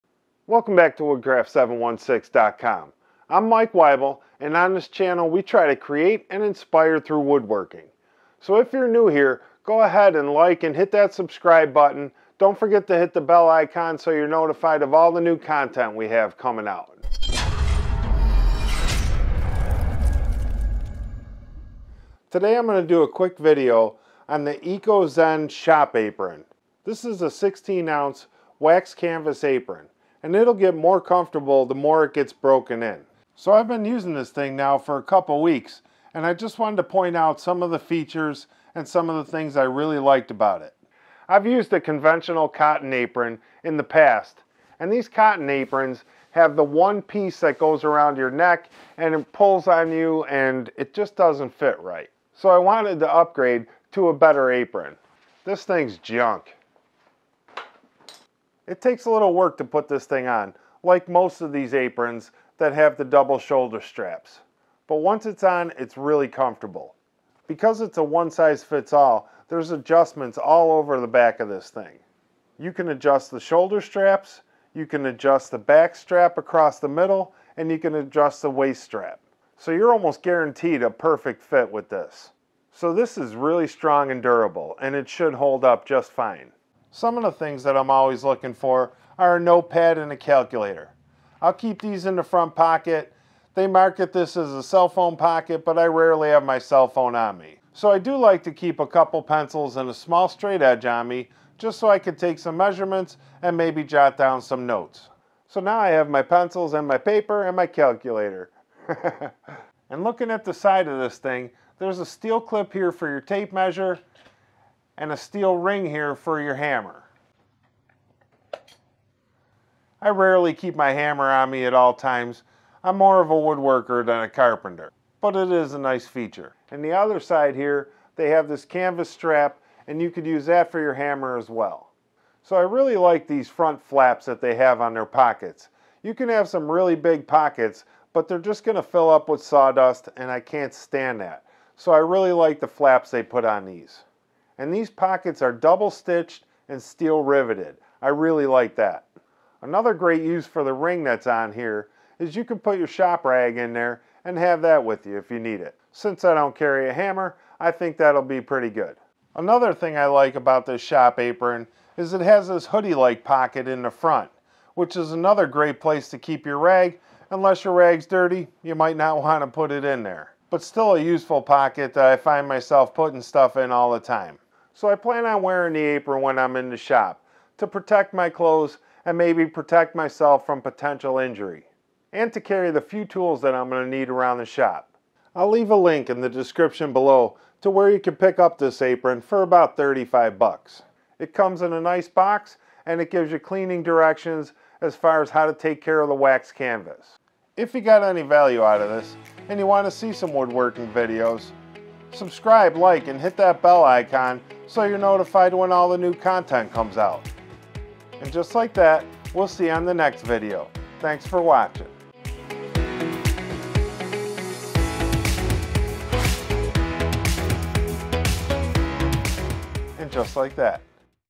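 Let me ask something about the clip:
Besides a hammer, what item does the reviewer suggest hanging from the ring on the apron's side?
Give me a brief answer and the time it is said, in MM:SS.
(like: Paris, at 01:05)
shop rag, at 02:32.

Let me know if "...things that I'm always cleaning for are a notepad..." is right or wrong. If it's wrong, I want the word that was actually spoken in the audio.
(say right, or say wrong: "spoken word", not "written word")
wrong: "looking", not "cleaning".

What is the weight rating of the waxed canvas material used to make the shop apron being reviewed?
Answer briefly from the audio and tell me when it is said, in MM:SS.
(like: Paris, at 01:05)
16 ounce, at 00:27.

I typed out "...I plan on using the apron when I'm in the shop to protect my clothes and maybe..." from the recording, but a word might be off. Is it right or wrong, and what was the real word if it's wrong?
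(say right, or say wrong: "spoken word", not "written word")
wrong: "wearing", not "using".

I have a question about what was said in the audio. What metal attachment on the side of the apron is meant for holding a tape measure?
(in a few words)
steel clip.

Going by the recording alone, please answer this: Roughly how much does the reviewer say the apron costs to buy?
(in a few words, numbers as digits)
$35.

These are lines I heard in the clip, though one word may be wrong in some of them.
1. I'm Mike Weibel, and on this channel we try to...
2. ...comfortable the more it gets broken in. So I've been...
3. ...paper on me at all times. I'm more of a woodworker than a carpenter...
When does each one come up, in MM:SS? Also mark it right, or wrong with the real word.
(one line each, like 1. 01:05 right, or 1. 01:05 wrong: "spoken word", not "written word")
1. 00:03 right
2. 00:31 right
3. 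02:00 wrong: "hammer", not "paper".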